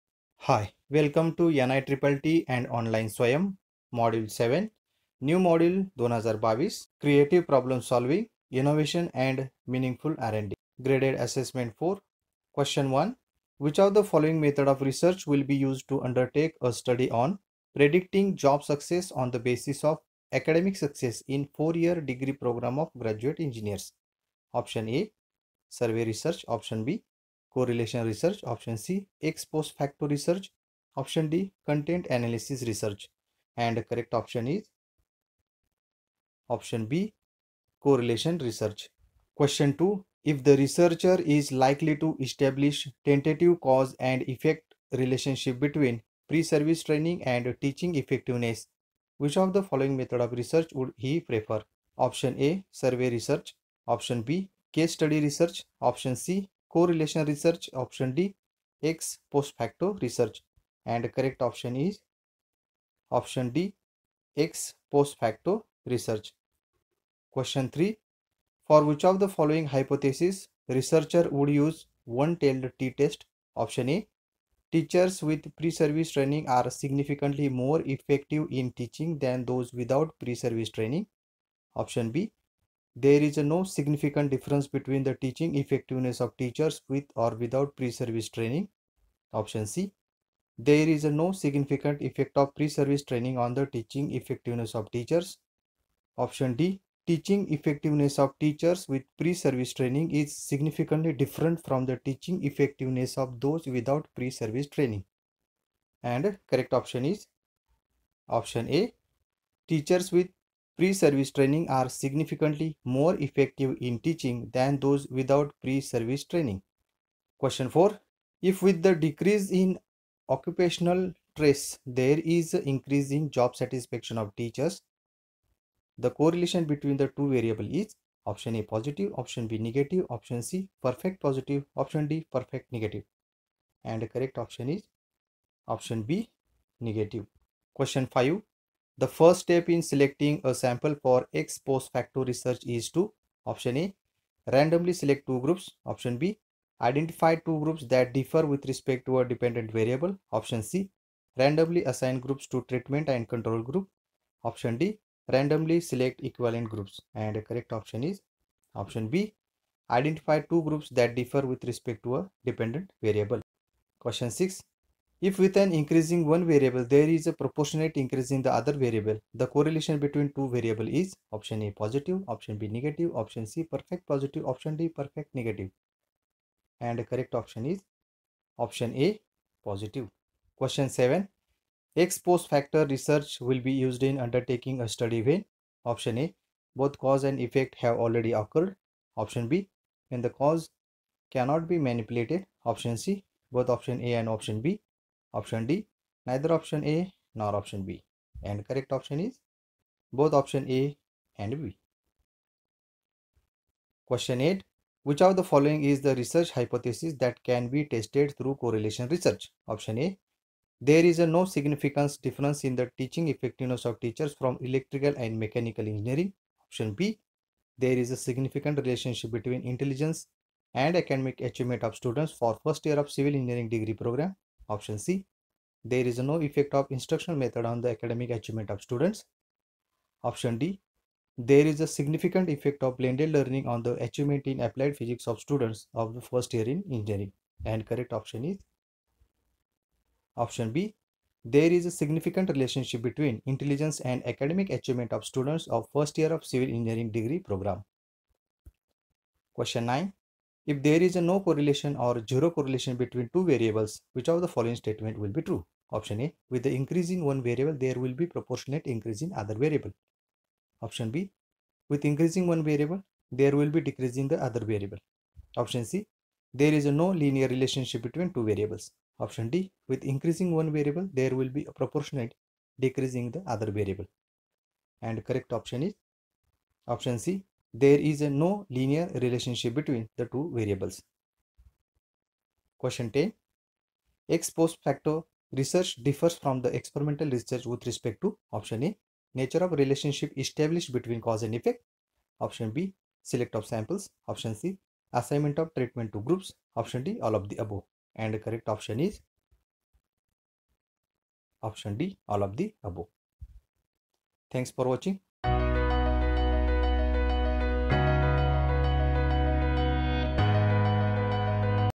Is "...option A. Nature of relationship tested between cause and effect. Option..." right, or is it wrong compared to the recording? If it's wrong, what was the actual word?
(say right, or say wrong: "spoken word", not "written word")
wrong: "established", not "tested".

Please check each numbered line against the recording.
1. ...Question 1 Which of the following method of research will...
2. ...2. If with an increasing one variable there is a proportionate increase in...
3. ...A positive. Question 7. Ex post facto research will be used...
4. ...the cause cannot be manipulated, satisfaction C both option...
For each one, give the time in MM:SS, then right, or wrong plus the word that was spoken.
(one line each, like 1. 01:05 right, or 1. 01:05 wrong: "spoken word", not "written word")
1. 00:12 right
2. 02:44 wrong: "6", not "2"
3. 02:58 right
4. 03:10 wrong: "option", not "satisfaction".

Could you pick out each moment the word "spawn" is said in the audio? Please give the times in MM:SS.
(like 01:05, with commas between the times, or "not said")
not said.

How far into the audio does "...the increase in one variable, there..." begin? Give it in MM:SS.
04:16.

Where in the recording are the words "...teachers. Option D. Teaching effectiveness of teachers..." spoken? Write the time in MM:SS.
01:34.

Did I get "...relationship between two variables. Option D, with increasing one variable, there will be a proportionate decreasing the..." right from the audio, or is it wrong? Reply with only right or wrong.
right.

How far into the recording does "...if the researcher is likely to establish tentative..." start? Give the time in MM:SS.
00:40.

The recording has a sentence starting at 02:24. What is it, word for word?
Randomly select two groups, option B.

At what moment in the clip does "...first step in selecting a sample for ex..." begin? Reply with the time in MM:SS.
02:19.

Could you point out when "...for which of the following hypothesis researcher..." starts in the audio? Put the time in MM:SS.
01:08.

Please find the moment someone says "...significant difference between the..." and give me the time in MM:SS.
01:23.